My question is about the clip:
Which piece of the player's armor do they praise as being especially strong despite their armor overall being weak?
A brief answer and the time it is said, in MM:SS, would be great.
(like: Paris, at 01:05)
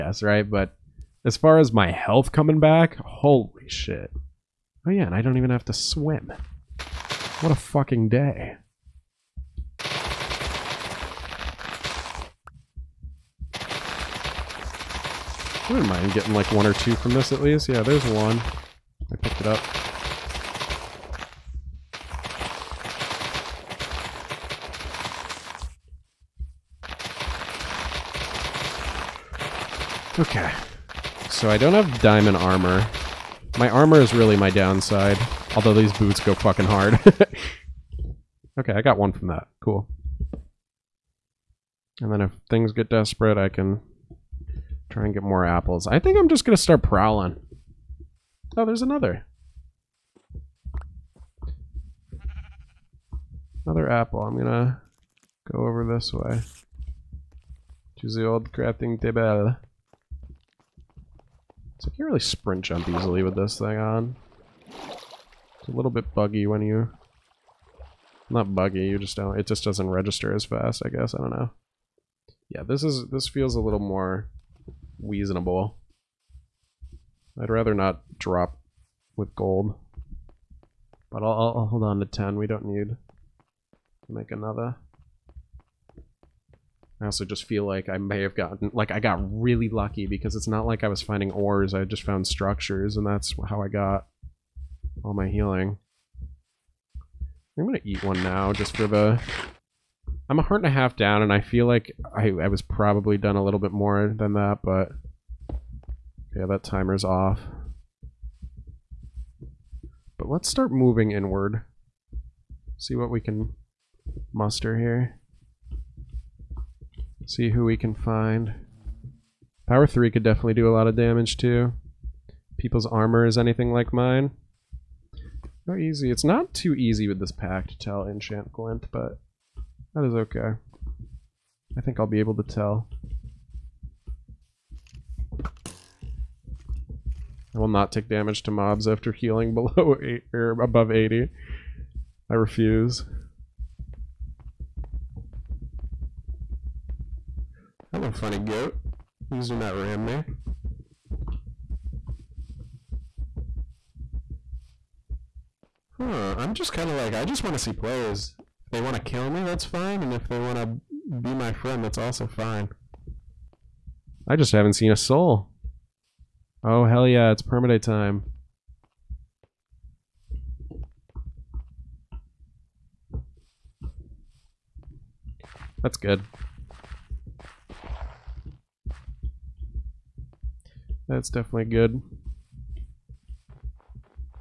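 Boots, at 00:35.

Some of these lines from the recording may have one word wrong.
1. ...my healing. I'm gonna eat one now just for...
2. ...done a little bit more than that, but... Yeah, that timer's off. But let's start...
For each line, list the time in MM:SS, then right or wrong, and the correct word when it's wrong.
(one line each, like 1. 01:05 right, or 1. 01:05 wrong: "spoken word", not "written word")
1. 01:35 right
2. 01:43 right.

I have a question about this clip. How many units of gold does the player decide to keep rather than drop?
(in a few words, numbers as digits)
10.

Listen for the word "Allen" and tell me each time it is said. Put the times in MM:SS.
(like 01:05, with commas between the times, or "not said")
not said.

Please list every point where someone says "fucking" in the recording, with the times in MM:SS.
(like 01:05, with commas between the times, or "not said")
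00:07, 00:36.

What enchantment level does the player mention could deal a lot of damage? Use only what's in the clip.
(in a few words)
Power 3.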